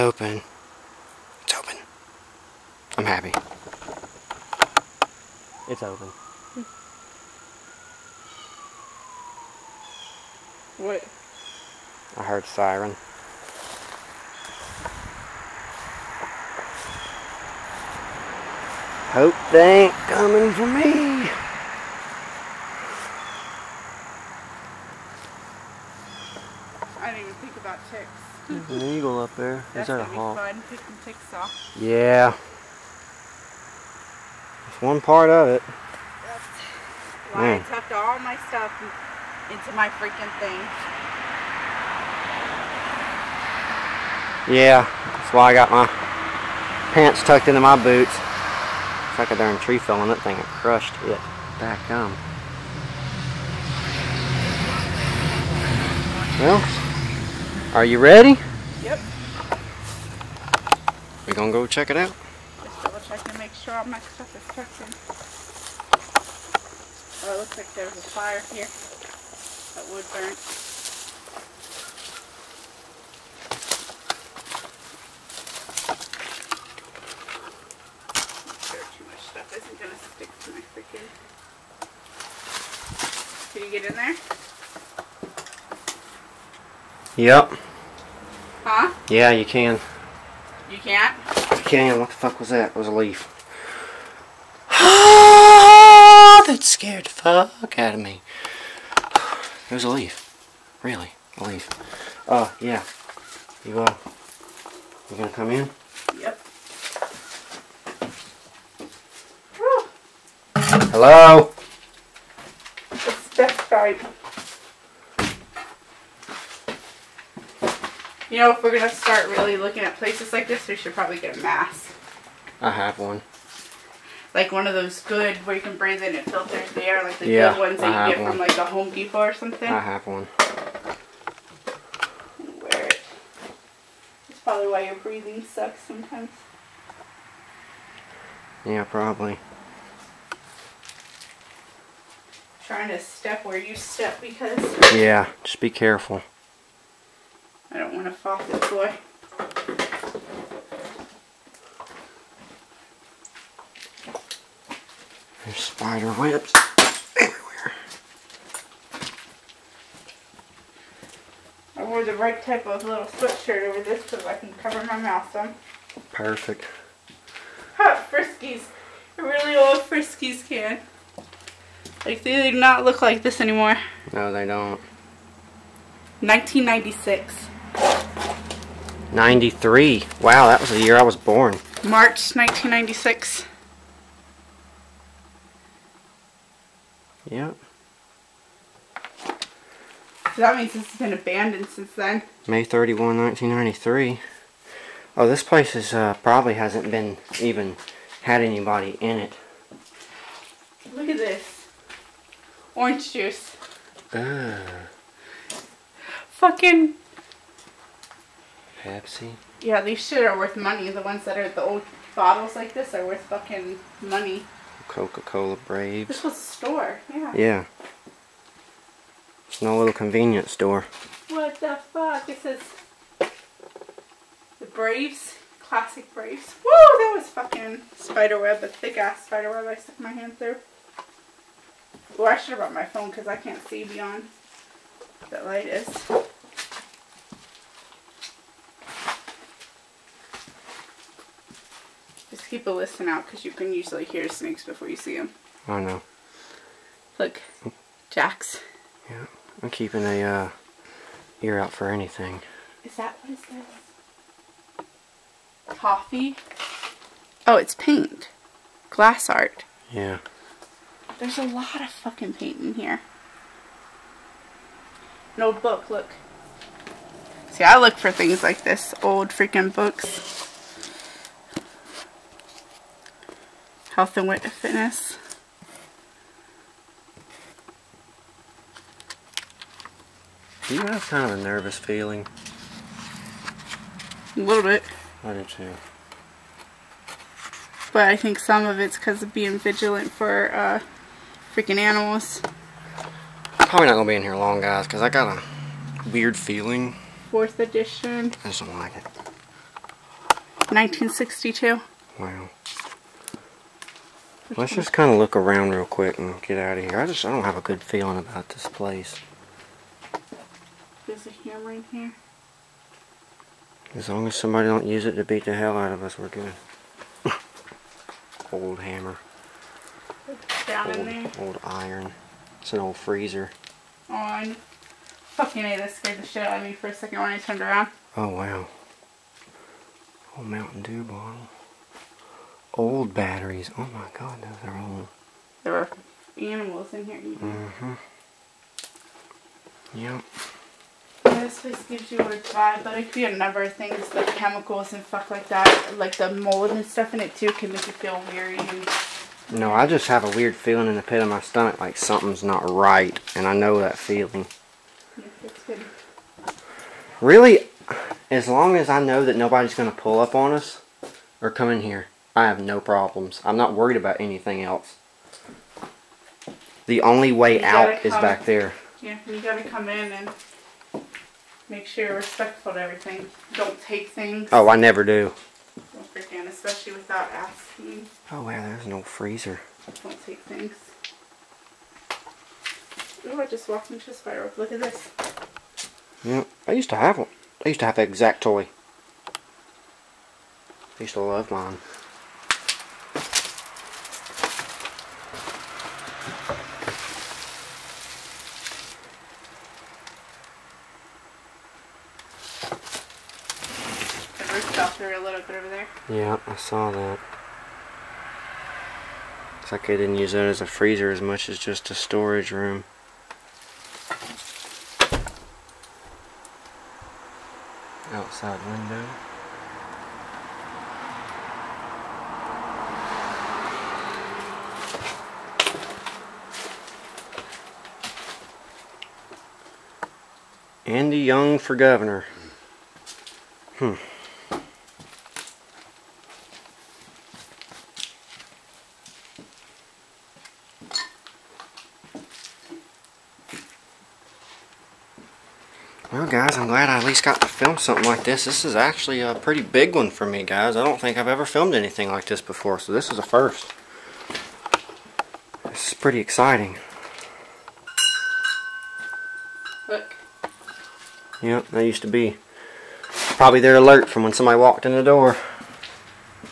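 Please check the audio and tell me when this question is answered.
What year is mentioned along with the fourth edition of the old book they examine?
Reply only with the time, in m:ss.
5:00.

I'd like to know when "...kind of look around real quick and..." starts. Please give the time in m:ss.
5:04.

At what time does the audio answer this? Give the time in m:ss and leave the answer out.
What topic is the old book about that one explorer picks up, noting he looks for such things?
4:34.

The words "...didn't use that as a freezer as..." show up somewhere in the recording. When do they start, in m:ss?
6:49.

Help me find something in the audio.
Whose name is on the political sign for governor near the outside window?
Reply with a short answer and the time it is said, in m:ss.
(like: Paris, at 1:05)
Andy Young, at 7:10.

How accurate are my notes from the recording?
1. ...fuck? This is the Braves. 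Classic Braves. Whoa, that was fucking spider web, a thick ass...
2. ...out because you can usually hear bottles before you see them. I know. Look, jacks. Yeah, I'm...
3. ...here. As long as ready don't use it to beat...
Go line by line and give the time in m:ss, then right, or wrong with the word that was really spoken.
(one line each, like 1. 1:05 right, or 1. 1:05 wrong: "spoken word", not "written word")
1. 3:41 right
2. 4:03 wrong: "snakes", not "bottles"
3. 5:11 wrong: "somebody", not "ready".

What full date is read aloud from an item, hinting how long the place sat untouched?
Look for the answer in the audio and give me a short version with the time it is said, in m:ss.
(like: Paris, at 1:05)
May 31, 1993, at 3:12.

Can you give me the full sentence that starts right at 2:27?
I don't want to fall through the floor.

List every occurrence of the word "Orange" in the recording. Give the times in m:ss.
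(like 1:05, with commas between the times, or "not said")
3:22.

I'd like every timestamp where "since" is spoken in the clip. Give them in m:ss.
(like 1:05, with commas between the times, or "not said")
3:11.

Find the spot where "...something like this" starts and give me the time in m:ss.
7:27.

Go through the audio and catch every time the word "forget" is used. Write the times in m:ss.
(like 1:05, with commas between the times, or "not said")
6:16.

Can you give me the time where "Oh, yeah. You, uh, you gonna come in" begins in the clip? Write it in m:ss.
1:42.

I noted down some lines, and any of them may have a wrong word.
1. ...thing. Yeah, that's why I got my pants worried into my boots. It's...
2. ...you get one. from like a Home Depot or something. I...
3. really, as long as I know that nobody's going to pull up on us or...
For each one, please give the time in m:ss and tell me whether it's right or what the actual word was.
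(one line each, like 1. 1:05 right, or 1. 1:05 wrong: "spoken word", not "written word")
1. 0:40 wrong: "tucked", not "worried"
2. 2:08 right
3. 5:57 right.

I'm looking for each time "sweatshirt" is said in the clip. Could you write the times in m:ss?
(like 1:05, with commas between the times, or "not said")
2:43.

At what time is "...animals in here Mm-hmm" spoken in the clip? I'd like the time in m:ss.
5:36.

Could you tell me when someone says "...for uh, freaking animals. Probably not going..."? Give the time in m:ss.
4:50.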